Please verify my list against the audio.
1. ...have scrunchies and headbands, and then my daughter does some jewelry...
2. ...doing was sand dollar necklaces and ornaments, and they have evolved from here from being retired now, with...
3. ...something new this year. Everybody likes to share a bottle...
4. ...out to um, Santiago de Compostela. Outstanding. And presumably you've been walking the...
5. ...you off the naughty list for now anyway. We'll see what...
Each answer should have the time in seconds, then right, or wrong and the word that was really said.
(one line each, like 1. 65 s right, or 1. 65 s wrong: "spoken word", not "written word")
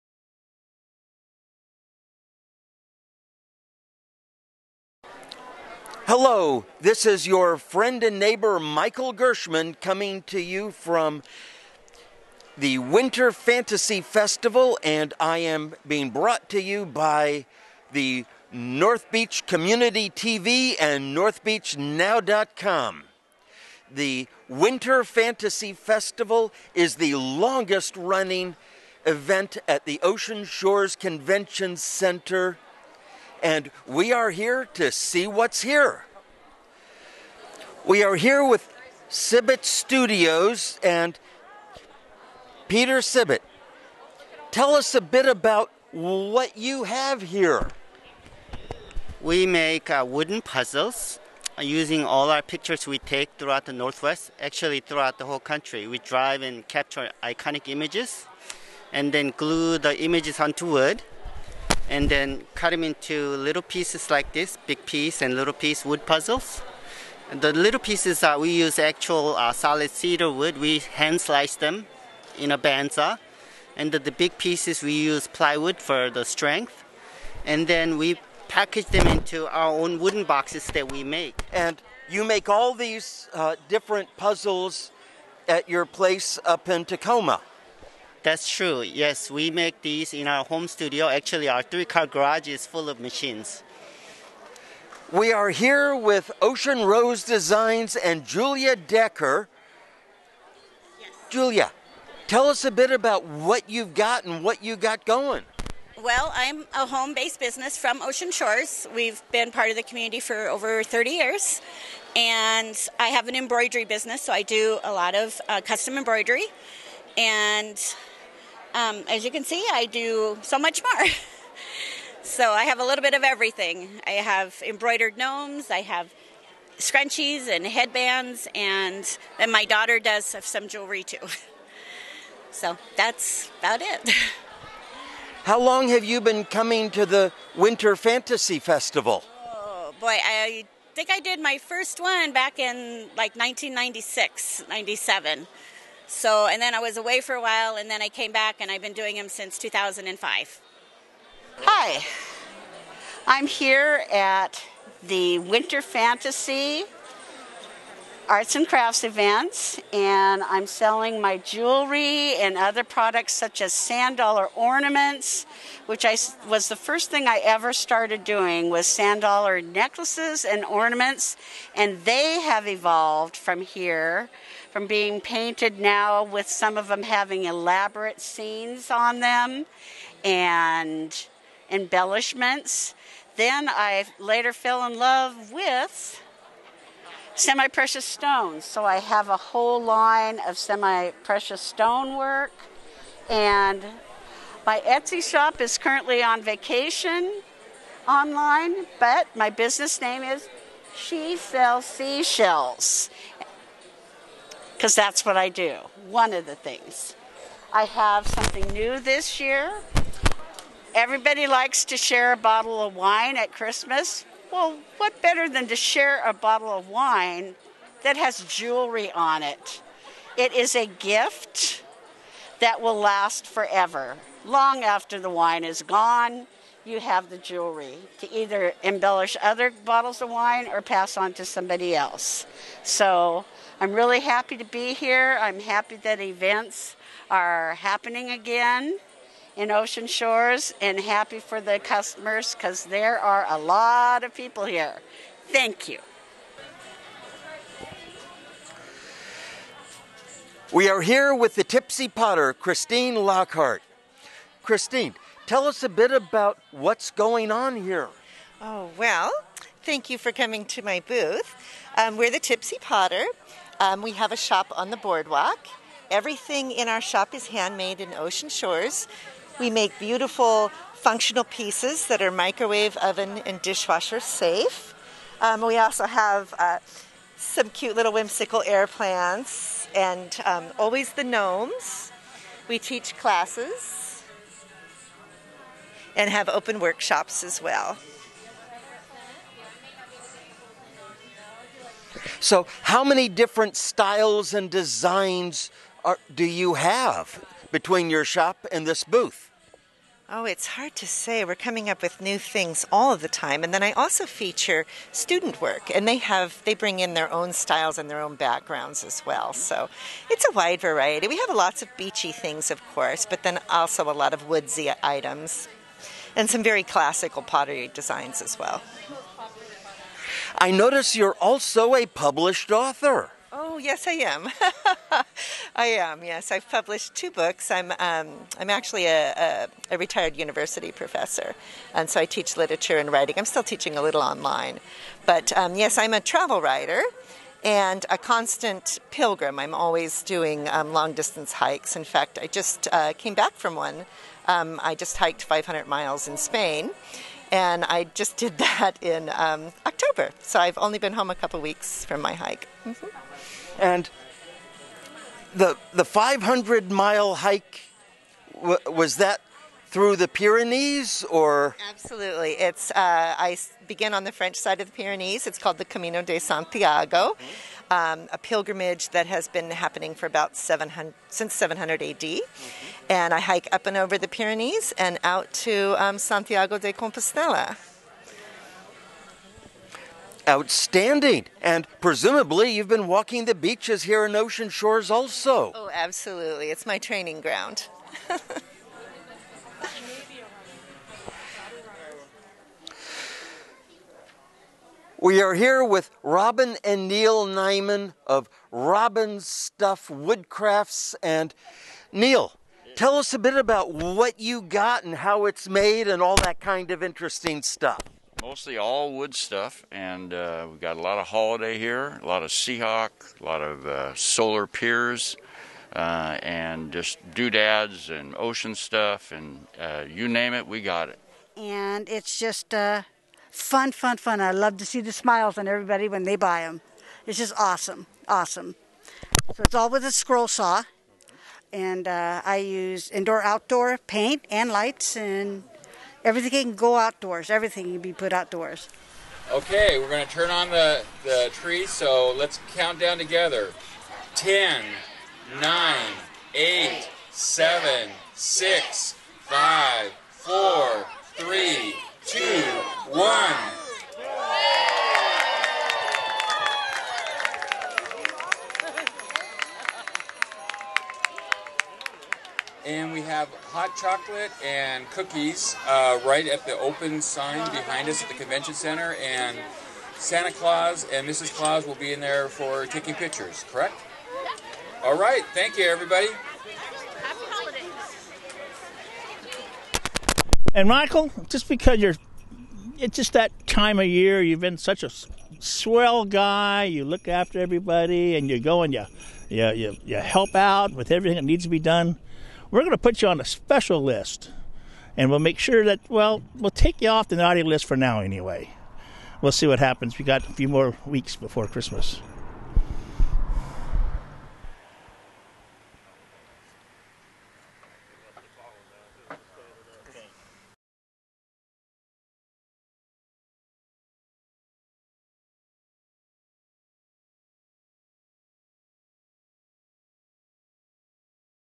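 1. 125 s right
2. 168 s wrong: "painted", not "retired"
3. 208 s right
4. 375 s right
5. 497 s right.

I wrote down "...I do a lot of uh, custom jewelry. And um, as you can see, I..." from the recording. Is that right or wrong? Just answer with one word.
wrong.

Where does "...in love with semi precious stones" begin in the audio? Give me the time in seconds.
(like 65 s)
184 s.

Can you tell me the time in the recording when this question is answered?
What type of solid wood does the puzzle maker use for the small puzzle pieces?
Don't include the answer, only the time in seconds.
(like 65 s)
69 s.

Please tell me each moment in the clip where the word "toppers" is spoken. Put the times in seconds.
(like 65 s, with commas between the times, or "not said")
not said.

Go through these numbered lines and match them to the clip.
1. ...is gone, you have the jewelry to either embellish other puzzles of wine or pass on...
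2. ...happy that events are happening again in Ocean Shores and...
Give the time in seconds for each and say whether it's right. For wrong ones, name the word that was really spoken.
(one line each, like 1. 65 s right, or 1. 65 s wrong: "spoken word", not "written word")
1. 225 s wrong: "bottles", not "puzzles"
2. 235 s right.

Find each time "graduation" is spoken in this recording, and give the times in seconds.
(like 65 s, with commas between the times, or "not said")
not said.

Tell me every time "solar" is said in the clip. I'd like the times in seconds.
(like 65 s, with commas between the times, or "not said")
414 s.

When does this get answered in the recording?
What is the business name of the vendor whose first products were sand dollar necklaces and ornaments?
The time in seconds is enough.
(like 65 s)
200 s.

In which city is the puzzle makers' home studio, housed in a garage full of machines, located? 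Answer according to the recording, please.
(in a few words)
Tacoma.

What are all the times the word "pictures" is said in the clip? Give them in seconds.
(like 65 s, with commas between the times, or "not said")
52 s, 473 s.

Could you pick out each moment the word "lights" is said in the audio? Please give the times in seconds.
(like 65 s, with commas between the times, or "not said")
434 s.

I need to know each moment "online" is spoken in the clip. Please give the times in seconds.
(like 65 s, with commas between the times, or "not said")
198 s, 334 s.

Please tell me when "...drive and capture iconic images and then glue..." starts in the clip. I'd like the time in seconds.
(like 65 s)
55 s.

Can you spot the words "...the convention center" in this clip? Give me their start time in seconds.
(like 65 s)
468 s.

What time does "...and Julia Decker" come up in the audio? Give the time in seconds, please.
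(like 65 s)
97 s.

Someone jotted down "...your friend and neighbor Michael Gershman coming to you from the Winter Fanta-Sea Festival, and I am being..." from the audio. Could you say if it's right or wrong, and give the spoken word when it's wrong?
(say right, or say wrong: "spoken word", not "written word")
right.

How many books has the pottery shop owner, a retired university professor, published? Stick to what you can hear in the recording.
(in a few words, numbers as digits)
2.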